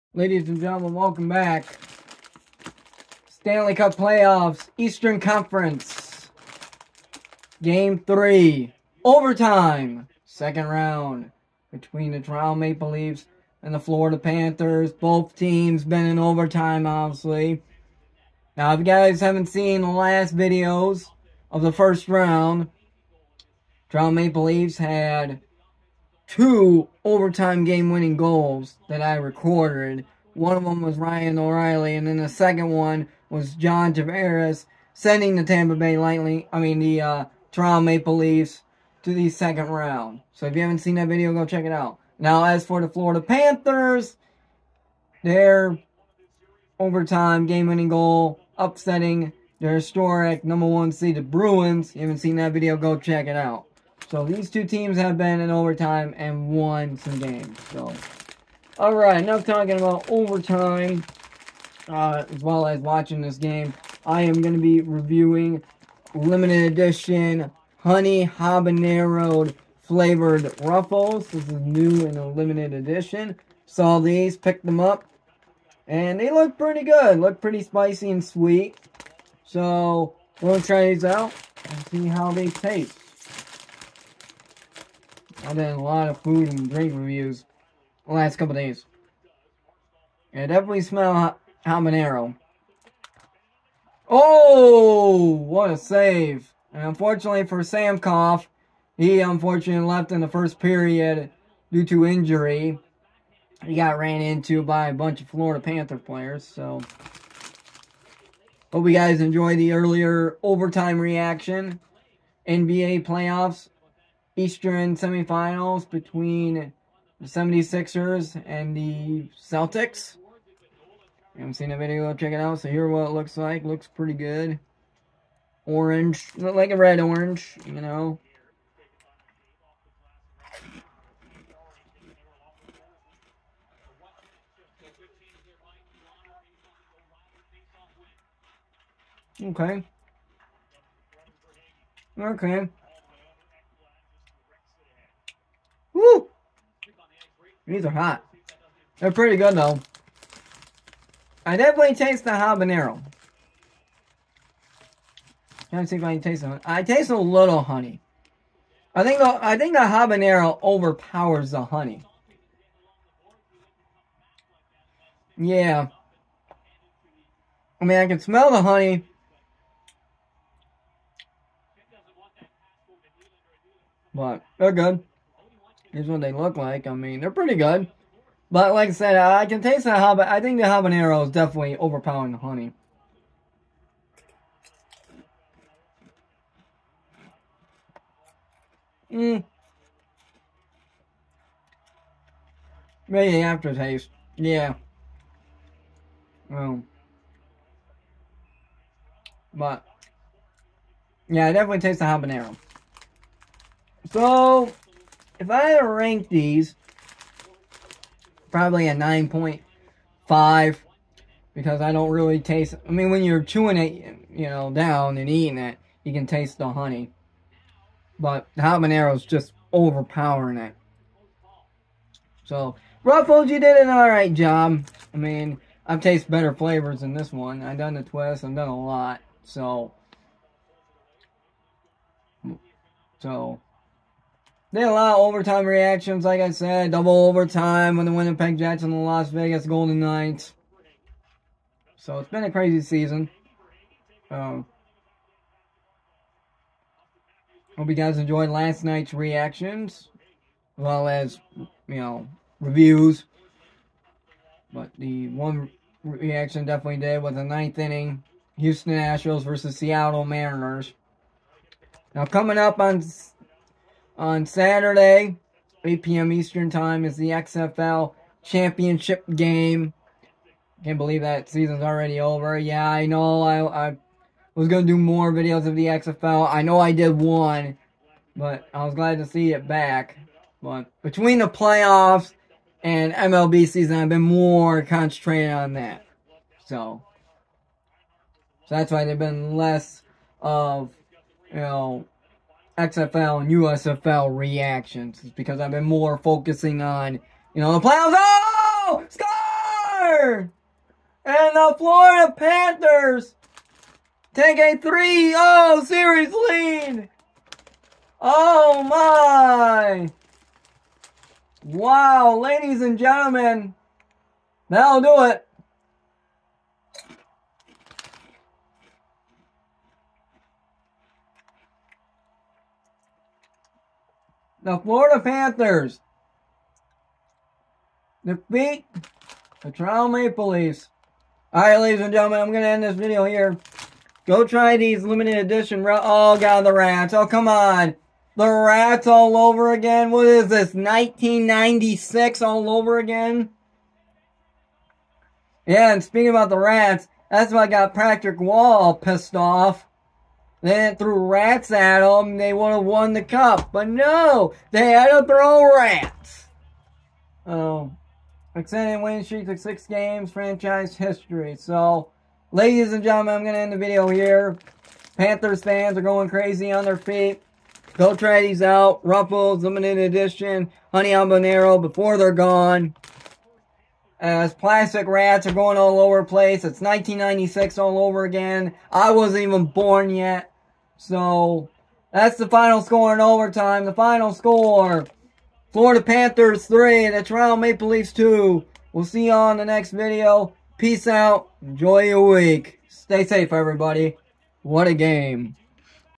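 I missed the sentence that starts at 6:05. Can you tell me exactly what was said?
Panthers fans are going crazy on their feet.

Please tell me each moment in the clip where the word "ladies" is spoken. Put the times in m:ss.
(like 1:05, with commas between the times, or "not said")
0:00, 5:12, 5:31, 6:02.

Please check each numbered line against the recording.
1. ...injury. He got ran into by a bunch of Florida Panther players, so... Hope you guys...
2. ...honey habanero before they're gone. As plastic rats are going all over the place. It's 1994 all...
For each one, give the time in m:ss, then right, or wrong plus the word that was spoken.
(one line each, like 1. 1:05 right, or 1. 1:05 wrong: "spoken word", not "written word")
1. 1:42 right
2. 6:10 wrong: "1996", not "1994".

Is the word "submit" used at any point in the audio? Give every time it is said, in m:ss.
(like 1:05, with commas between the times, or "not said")
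not said.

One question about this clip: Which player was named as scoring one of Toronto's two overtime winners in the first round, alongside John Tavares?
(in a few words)
Ryan O'Reilly.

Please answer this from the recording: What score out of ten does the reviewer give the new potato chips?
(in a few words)
9.5.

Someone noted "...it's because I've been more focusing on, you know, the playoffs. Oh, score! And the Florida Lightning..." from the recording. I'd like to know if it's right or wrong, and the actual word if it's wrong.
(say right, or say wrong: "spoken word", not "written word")
wrong: "Panthers", not "Lightning".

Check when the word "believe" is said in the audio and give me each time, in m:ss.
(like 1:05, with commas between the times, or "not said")
4:30.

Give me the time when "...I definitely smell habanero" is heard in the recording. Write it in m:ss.
1:30.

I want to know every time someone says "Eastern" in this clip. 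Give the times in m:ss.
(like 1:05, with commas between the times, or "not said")
0:04, 1:54, 4:26.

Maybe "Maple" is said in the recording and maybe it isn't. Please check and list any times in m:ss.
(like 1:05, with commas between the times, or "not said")
0:12, 0:24, 0:37, 5:30, 6:27.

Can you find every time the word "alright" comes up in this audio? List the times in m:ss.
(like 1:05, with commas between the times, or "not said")
3:43, 5:31.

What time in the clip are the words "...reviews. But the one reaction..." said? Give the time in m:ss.
4:12.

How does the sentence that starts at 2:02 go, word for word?
So here what it looks like.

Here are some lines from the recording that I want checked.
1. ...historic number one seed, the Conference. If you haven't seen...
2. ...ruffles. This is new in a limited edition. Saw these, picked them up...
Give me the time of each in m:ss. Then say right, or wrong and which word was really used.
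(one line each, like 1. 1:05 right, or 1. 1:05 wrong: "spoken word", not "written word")
1. 0:49 wrong: "Bruins", not "Conference"
2. 1:10 right.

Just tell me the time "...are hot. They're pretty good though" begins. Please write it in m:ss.
2:27.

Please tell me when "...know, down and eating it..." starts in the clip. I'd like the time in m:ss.
3:34.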